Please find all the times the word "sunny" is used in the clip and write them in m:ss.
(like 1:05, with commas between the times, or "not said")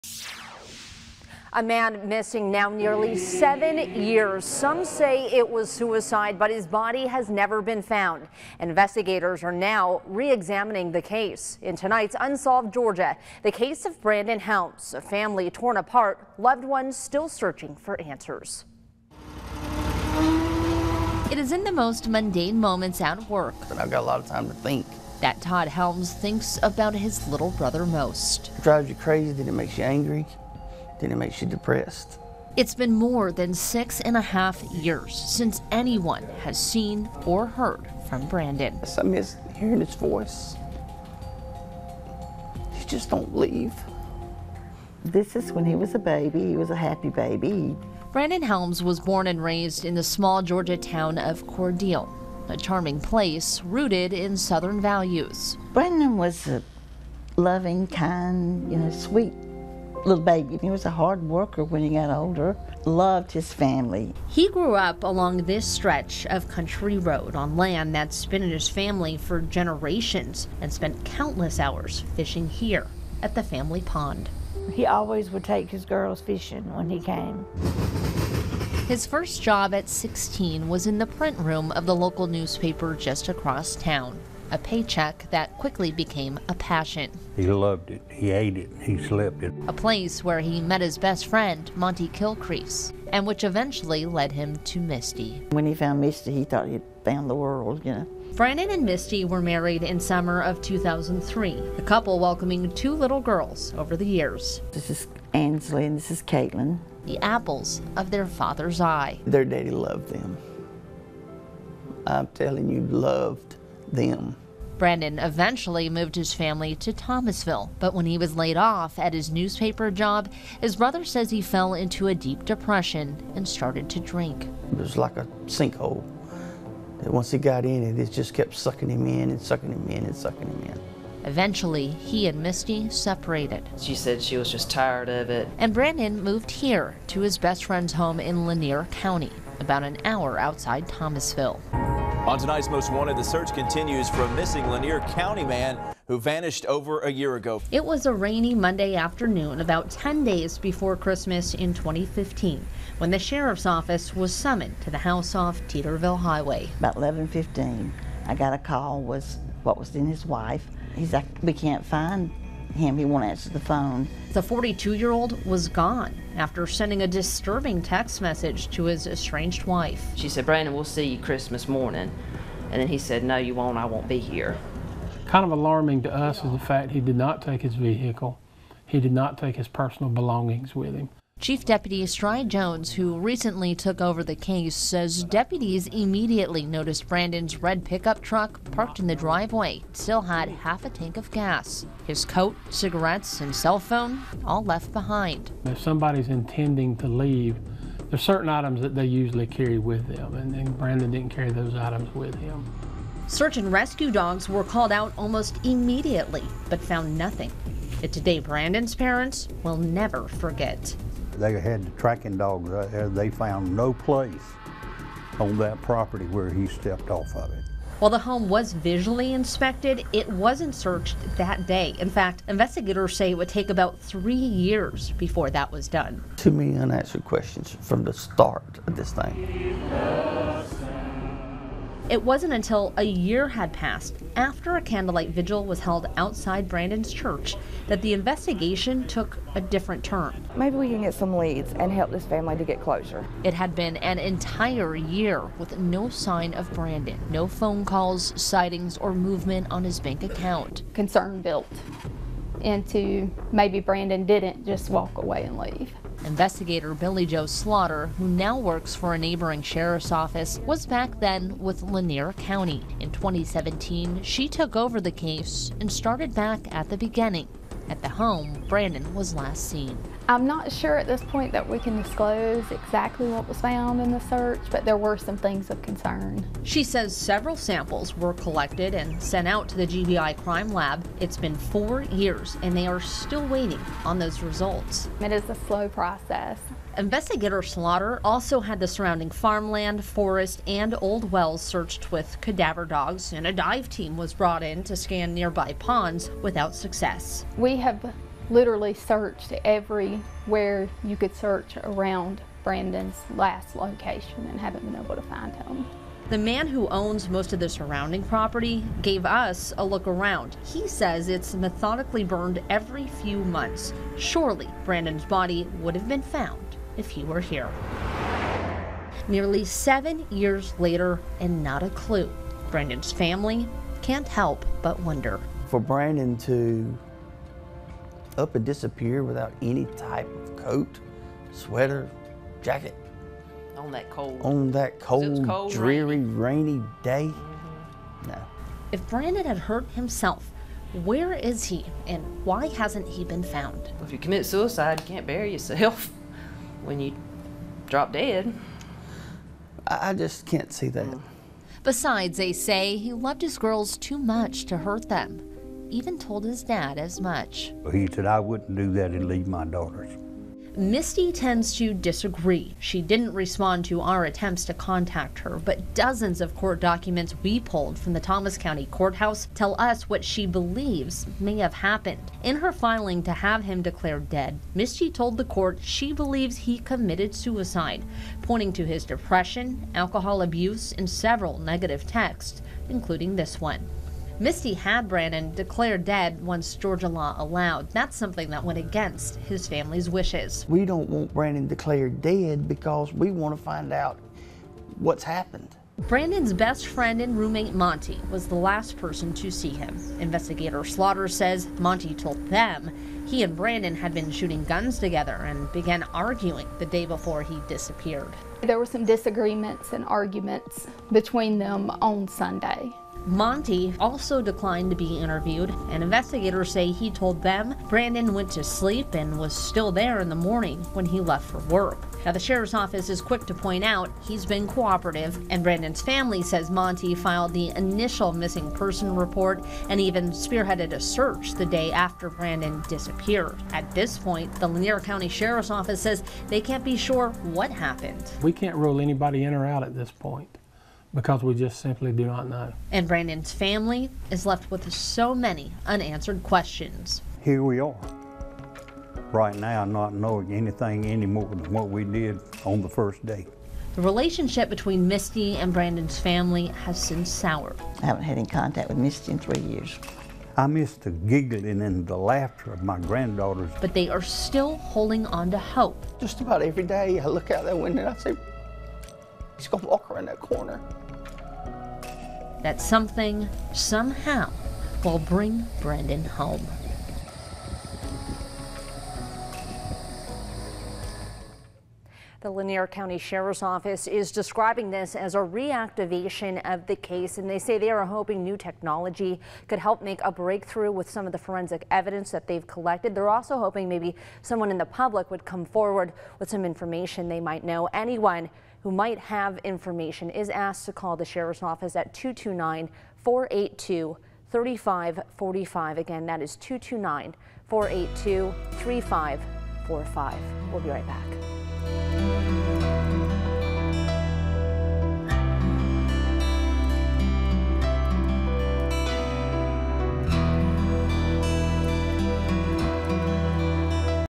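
not said.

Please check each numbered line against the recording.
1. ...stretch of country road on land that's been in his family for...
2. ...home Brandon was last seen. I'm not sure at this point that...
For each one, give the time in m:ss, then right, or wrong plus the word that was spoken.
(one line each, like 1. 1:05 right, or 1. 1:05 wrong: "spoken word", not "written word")
1. 1:05 right
2. 4:28 right.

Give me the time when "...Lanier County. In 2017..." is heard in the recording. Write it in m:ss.
4:21.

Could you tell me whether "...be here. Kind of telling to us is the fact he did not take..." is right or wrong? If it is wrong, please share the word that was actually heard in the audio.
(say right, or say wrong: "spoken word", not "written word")
wrong: "alarming", not "telling".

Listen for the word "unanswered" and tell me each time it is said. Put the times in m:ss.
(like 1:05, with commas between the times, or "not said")
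3:46, 7:25.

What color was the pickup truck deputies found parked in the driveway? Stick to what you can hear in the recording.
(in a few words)
Red.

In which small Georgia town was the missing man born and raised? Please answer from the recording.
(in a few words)
Cordele.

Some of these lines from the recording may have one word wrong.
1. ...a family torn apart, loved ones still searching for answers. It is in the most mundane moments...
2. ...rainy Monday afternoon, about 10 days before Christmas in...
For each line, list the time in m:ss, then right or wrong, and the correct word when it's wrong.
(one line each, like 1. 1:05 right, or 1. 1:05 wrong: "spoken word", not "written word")
1. 0:14 right
2. 2:28 right.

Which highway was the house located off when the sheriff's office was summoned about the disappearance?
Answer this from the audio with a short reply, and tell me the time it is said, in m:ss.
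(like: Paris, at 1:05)
Teeterville Highway, at 2:35.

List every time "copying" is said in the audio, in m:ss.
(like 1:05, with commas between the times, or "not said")
not said.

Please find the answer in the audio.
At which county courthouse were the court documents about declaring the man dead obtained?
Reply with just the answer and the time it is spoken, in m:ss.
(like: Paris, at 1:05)
Thomas County, at 6:08.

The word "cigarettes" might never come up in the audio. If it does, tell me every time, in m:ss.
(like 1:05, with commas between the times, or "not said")
3:12.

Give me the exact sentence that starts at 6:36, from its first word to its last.
Brandon's best friend and roommate Monty was the last person to see him.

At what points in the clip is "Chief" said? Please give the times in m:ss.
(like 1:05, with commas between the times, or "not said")
3:01.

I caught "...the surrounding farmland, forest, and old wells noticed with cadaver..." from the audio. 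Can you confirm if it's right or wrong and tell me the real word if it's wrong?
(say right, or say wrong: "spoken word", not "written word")
wrong: "searched", not "noticed".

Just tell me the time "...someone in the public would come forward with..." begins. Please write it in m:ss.
8:14.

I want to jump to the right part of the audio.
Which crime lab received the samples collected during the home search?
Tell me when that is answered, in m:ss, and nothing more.
4:39.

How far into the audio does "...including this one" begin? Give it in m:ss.
6:22.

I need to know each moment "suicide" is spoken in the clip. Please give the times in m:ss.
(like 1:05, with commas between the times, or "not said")
0:05, 5:44, 6:17.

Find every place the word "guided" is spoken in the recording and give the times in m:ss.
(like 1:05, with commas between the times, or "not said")
not said.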